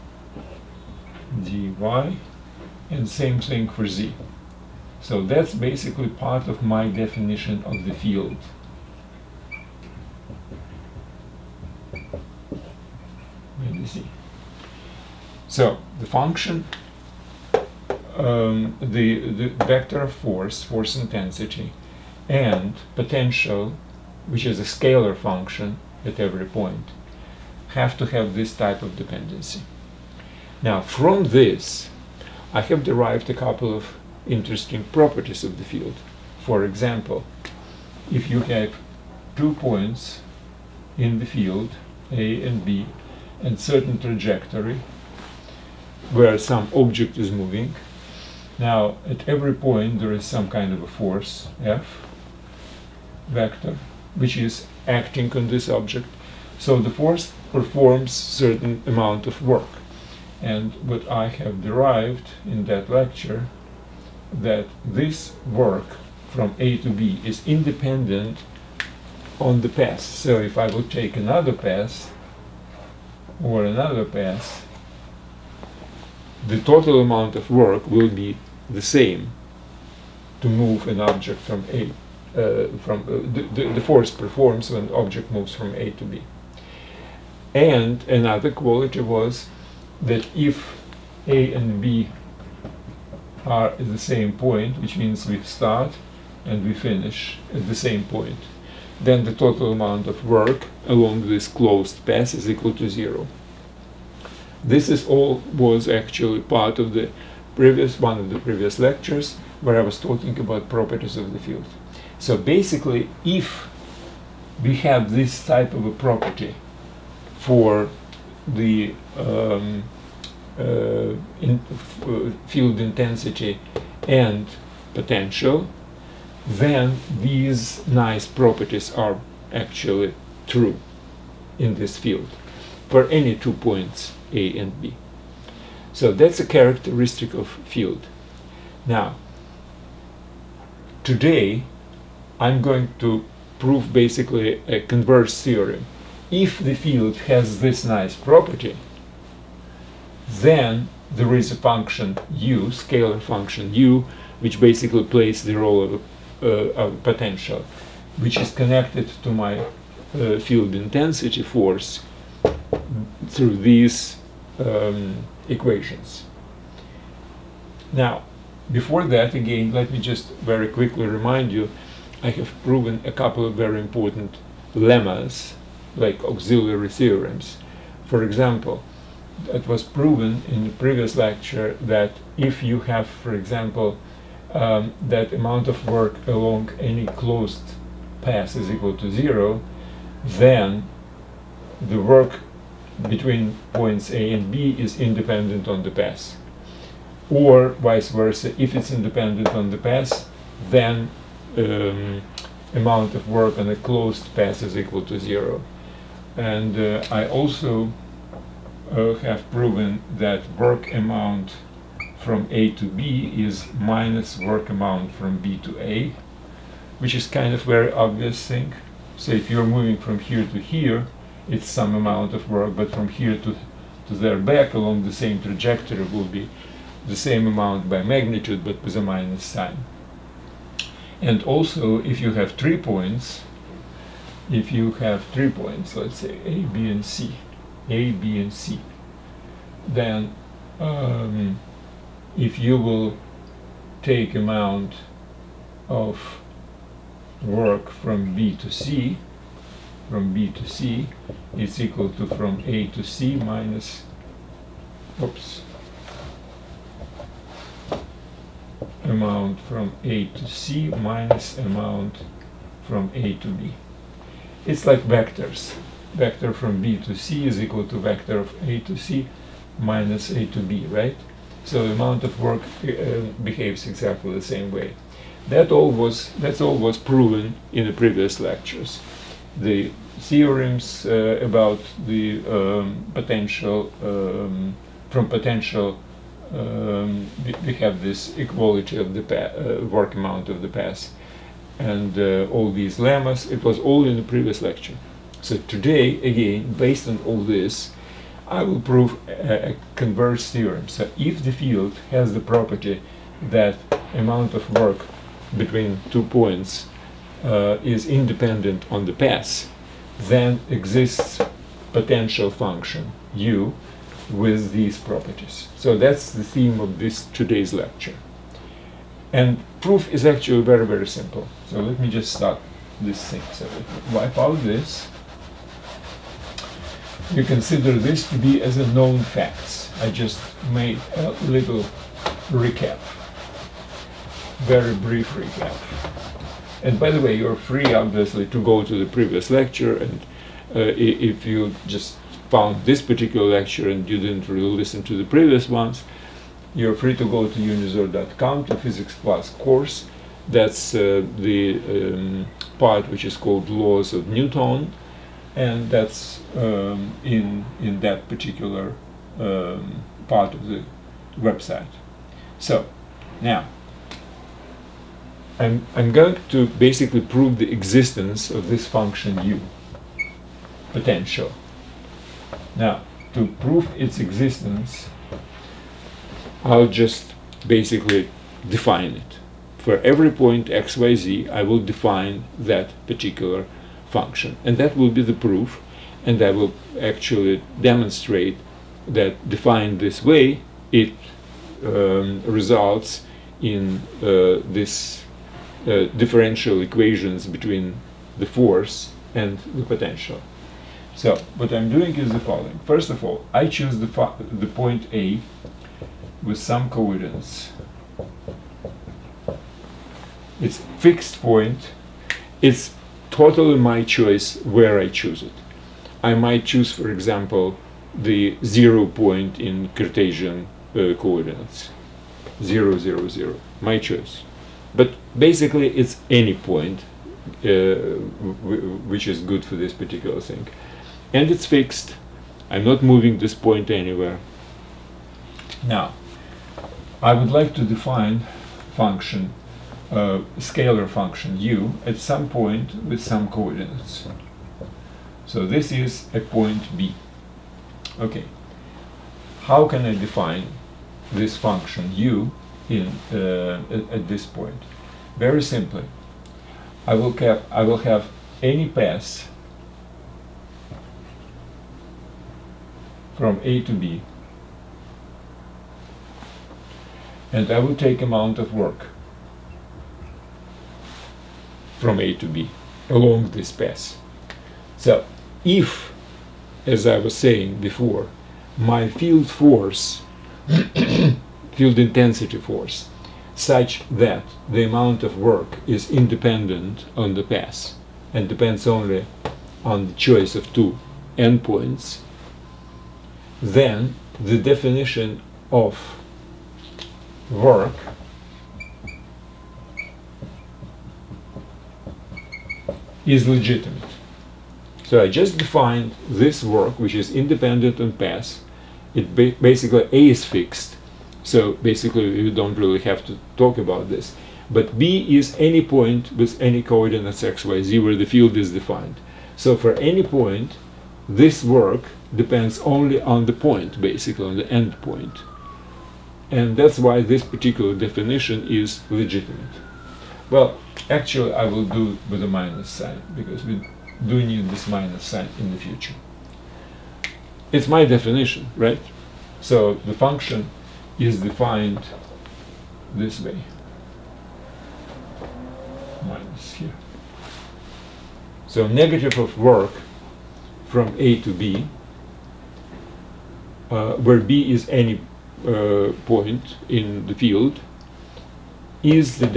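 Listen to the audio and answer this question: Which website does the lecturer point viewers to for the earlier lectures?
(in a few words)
unizor.com.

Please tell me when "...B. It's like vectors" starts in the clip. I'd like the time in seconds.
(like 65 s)
263 s.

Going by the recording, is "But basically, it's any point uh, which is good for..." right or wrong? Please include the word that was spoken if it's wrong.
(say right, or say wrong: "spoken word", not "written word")
right.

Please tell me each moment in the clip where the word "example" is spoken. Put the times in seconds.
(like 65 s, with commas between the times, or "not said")
36 s, 178 s, 183 s, 417 s.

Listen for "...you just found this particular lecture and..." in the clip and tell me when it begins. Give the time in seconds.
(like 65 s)
341 s.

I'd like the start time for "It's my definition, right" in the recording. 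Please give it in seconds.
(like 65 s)
537 s.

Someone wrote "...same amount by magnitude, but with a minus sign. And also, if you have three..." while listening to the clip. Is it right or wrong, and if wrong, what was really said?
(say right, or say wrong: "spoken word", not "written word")
right.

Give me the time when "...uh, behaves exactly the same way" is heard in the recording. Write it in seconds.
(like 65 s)
272 s.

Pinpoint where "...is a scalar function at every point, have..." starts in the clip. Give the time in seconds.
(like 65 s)
24 s.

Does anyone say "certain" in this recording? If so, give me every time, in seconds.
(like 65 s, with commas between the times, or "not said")
43 s, 58 s.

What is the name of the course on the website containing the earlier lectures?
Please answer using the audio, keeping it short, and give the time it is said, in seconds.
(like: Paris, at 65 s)
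Physics Plus, at 348 s.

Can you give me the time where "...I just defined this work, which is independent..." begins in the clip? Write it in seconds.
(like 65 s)
505 s.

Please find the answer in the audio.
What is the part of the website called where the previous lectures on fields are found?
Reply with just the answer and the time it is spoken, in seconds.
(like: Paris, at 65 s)
Laws of Newton, at 353 s.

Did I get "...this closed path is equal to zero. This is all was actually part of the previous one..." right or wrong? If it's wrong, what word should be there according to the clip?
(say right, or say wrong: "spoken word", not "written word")
right.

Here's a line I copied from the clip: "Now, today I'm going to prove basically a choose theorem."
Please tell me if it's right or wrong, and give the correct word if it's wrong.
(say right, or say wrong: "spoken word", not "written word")
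wrong: "converse", not "choose".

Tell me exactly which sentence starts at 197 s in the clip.
Or vice versa, if it's independent on the path, then um, amount of work on a closed path is equal to zero.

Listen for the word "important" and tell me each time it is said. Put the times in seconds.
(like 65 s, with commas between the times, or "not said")
173 s.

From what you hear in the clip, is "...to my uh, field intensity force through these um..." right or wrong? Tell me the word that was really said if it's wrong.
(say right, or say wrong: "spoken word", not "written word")
right.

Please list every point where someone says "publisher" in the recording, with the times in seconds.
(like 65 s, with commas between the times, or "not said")
not said.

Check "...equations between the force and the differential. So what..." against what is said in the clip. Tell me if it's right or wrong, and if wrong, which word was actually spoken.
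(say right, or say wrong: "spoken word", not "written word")
wrong: "potential", not "differential".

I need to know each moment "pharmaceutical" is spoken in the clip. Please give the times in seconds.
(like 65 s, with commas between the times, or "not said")
not said.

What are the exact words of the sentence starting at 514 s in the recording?
But B is any point with any coordinates x, y, z where the field is defined.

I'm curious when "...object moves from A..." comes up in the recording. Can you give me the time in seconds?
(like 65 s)
84 s.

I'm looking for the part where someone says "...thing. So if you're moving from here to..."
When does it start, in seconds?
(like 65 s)
218 s.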